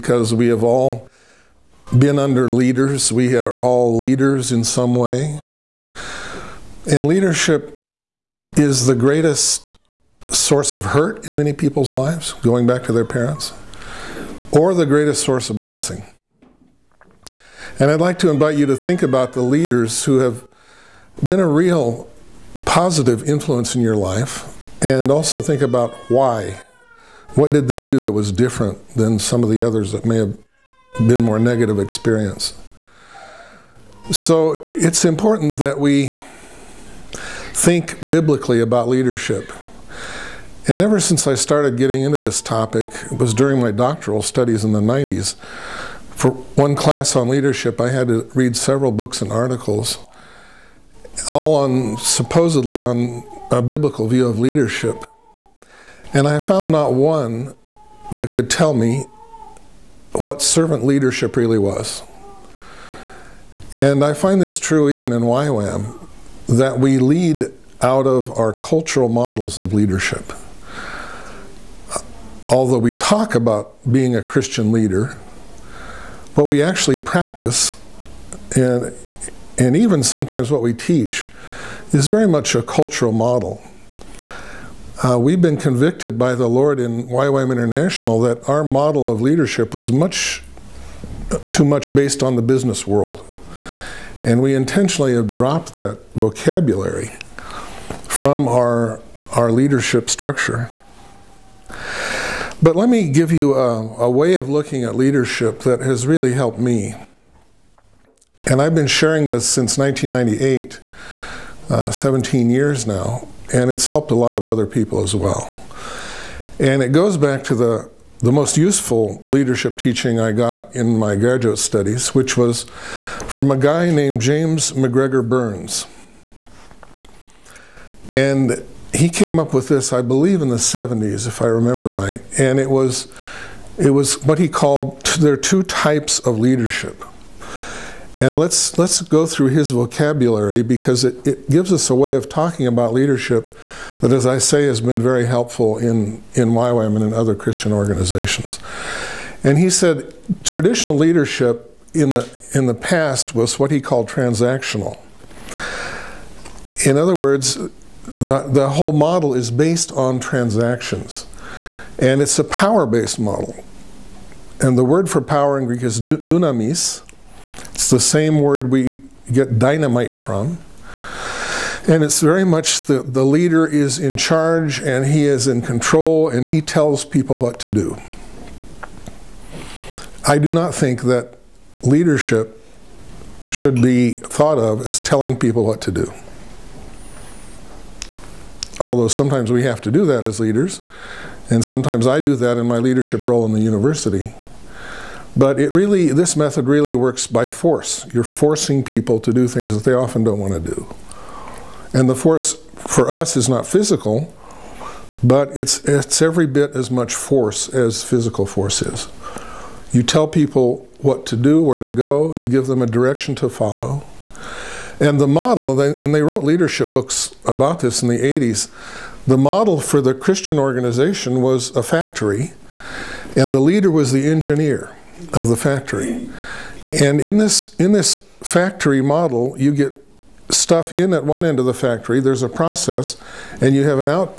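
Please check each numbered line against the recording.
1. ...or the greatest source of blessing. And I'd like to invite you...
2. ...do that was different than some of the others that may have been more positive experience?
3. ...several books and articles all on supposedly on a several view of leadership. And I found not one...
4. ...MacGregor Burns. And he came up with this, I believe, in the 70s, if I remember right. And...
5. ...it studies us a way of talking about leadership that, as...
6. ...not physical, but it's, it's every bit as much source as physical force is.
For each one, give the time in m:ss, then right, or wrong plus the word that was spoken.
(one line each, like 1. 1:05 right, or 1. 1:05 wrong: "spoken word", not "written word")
1. 0:14 right
2. 0:27 wrong: "negative", not "positive"
3. 0:48 wrong: "biblical", not "several"
4. 2:04 right
5. 2:21 wrong: "gives", not "studies"
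6. 3:23 wrong: "force", not "source".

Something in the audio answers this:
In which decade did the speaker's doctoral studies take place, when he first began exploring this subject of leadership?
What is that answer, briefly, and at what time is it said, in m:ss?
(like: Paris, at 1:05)
1990s, at 0:44.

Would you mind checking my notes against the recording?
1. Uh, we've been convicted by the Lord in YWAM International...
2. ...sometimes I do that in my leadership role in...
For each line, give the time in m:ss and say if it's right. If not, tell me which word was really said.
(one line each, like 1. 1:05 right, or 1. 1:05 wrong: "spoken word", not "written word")
1. 1:25 right
2. 3:11 right.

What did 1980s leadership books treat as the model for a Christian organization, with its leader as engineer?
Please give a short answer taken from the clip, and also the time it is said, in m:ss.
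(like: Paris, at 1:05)
A factory, at 3:41.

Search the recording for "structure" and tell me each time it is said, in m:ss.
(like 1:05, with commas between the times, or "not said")
1:40.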